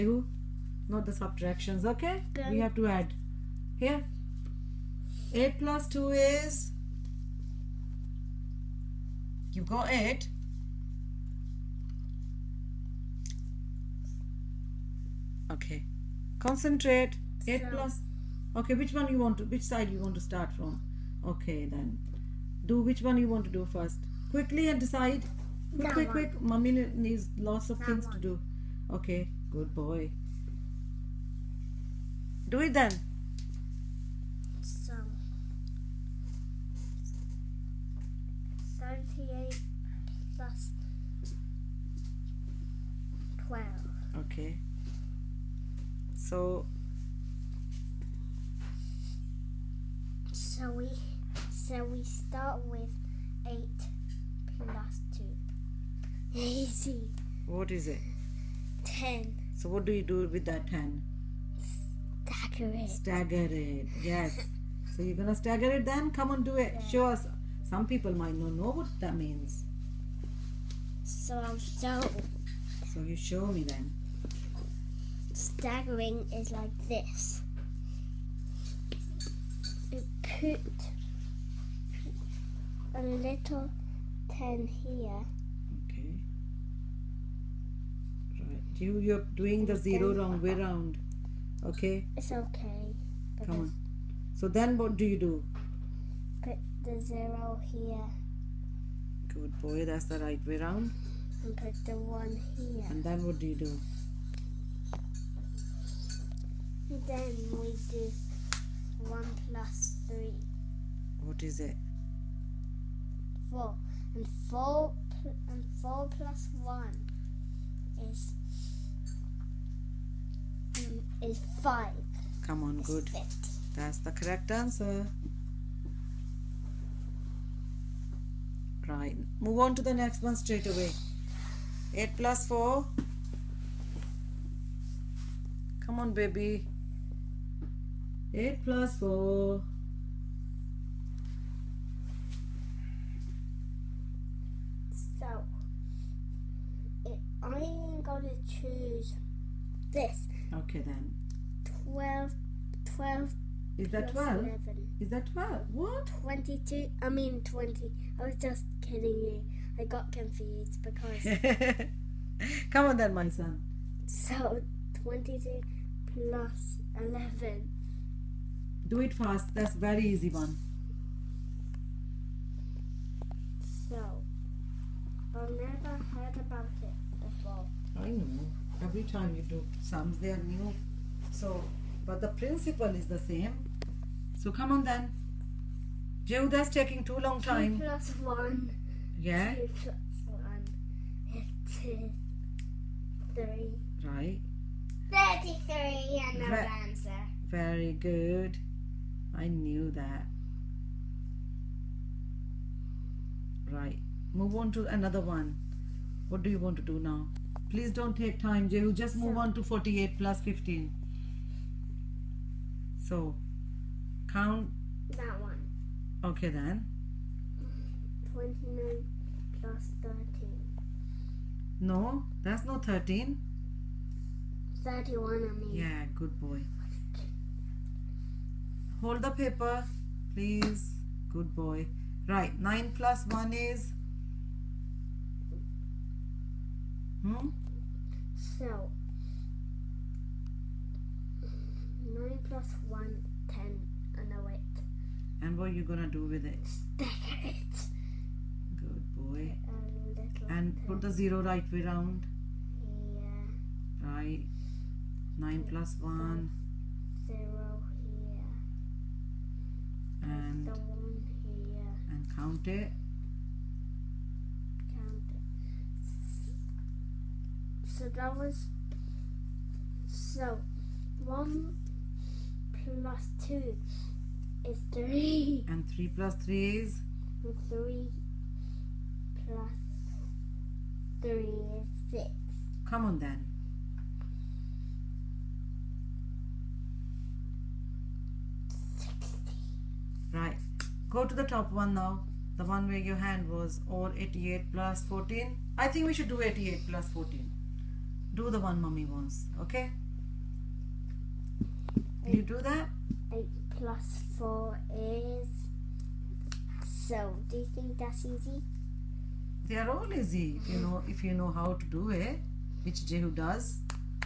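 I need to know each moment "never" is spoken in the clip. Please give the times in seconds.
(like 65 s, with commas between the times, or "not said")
175 s.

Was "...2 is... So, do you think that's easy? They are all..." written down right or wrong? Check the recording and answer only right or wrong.
wrong.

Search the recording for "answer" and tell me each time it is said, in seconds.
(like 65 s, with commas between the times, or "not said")
124 s, 196 s.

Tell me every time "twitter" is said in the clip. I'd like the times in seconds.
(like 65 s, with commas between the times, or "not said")
not said.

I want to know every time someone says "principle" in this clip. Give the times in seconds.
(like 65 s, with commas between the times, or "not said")
182 s.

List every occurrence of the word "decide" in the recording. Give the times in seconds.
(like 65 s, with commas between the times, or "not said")
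24 s.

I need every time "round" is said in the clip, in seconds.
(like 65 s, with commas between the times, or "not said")
90 s, 100 s, 251 s.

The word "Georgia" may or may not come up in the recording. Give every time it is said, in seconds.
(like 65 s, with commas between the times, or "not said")
not said.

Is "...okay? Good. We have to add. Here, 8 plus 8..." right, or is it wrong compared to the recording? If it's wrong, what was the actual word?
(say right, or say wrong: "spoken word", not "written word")
wrong: "2", not "8".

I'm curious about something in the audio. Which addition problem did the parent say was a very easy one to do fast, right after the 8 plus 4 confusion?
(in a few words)
22 plus 11.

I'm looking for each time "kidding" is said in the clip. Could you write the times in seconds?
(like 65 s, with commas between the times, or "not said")
158 s.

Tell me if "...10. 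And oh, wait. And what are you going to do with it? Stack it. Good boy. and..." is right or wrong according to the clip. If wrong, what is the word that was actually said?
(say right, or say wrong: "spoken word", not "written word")
right.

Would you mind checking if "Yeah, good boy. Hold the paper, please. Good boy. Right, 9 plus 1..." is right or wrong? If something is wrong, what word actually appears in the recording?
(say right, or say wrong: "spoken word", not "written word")
right.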